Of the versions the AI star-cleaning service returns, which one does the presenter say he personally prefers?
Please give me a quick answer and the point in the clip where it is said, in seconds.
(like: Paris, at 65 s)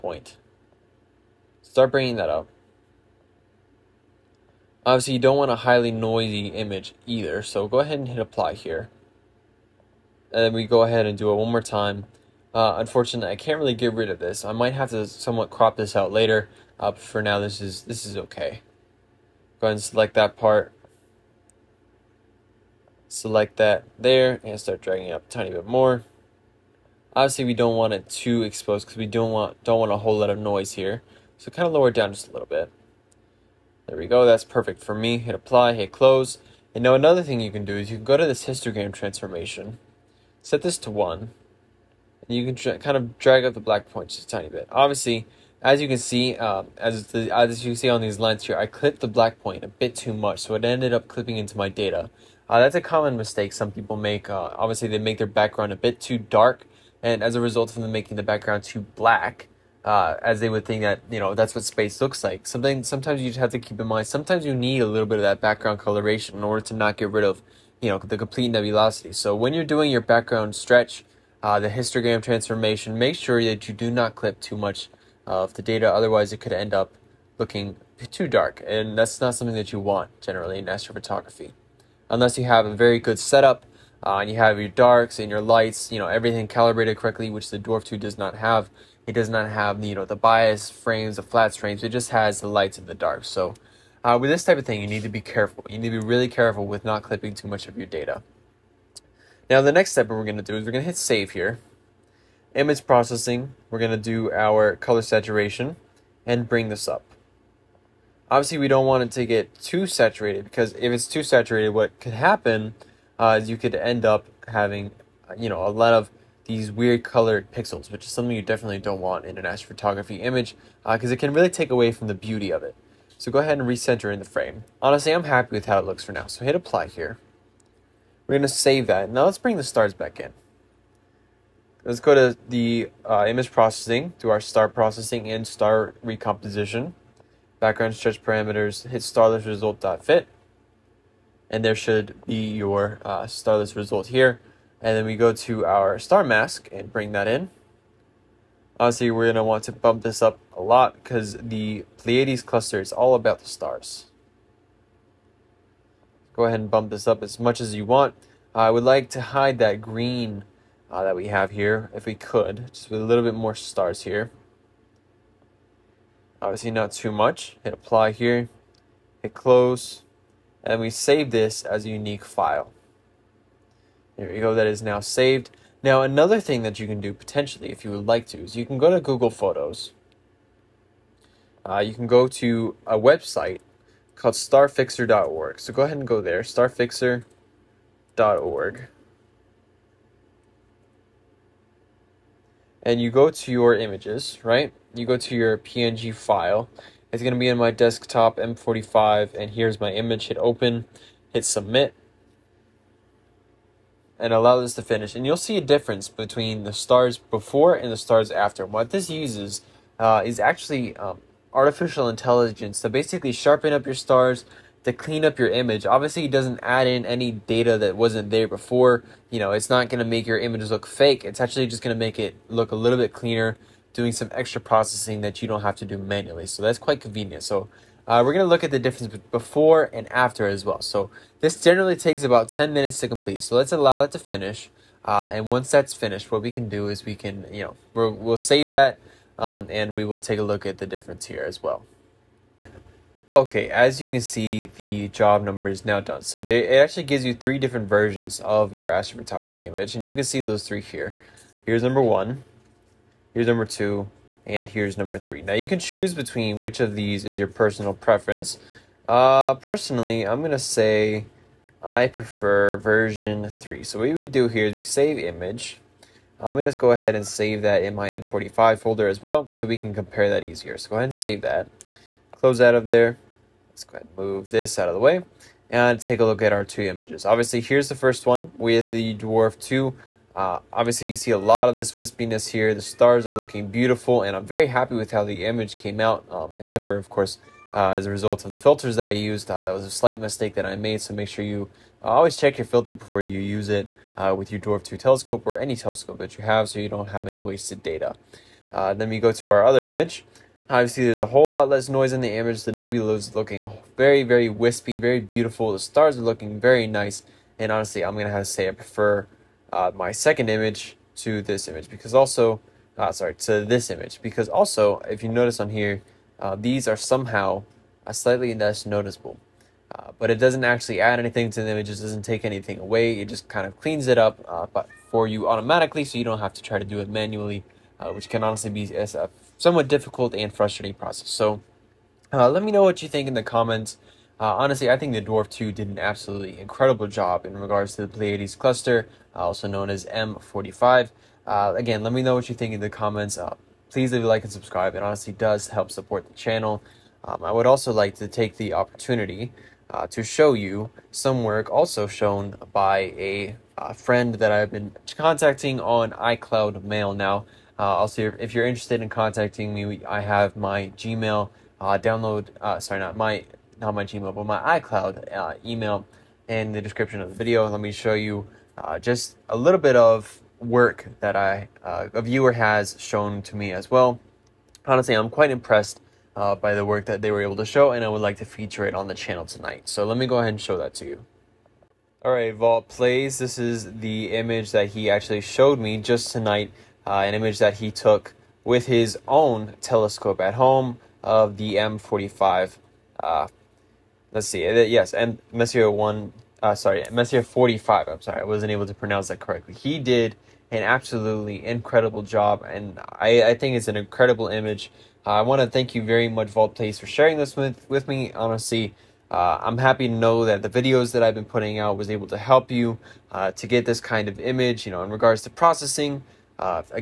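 version 3, at 262 s.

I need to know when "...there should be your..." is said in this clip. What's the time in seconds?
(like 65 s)
141 s.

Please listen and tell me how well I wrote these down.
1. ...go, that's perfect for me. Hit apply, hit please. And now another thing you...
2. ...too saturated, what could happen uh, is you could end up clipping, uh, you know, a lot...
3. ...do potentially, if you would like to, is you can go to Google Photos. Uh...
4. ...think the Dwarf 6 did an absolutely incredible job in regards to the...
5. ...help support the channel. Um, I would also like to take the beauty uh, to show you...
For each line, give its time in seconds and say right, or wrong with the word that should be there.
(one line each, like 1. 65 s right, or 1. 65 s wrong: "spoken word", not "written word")
1. 34 s wrong: "close", not "please"
2. 111 s wrong: "having", not "clipping"
3. 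177 s right
4. 334 s wrong: "2", not "6"
5. 345 s wrong: "opportunity", not "beauty".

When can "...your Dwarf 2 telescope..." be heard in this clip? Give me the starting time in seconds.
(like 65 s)
294 s.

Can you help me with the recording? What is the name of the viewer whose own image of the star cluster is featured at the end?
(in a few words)
Vault Plays.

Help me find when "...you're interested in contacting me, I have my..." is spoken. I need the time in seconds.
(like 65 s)
358 s.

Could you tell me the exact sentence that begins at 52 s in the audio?
Uh, that's a common mistake some people make.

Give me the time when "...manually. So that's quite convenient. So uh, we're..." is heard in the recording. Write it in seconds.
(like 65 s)
225 s.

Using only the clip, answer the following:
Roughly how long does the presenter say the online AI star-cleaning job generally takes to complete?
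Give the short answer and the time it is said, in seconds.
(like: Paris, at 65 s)
10 minutes, at 232 s.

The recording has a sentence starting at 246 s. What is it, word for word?
So they, it actually gives you three different versions of your astrophotography image.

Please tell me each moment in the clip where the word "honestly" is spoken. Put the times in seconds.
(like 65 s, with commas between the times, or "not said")
124 s, 307 s, 328 s, 334 s, 345 s, 374 s, 408 s.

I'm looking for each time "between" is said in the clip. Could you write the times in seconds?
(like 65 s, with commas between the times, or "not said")
206 s, 256 s.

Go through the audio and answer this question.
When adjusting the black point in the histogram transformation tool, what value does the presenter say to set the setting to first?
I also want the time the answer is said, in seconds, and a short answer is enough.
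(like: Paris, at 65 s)
1, at 40 s.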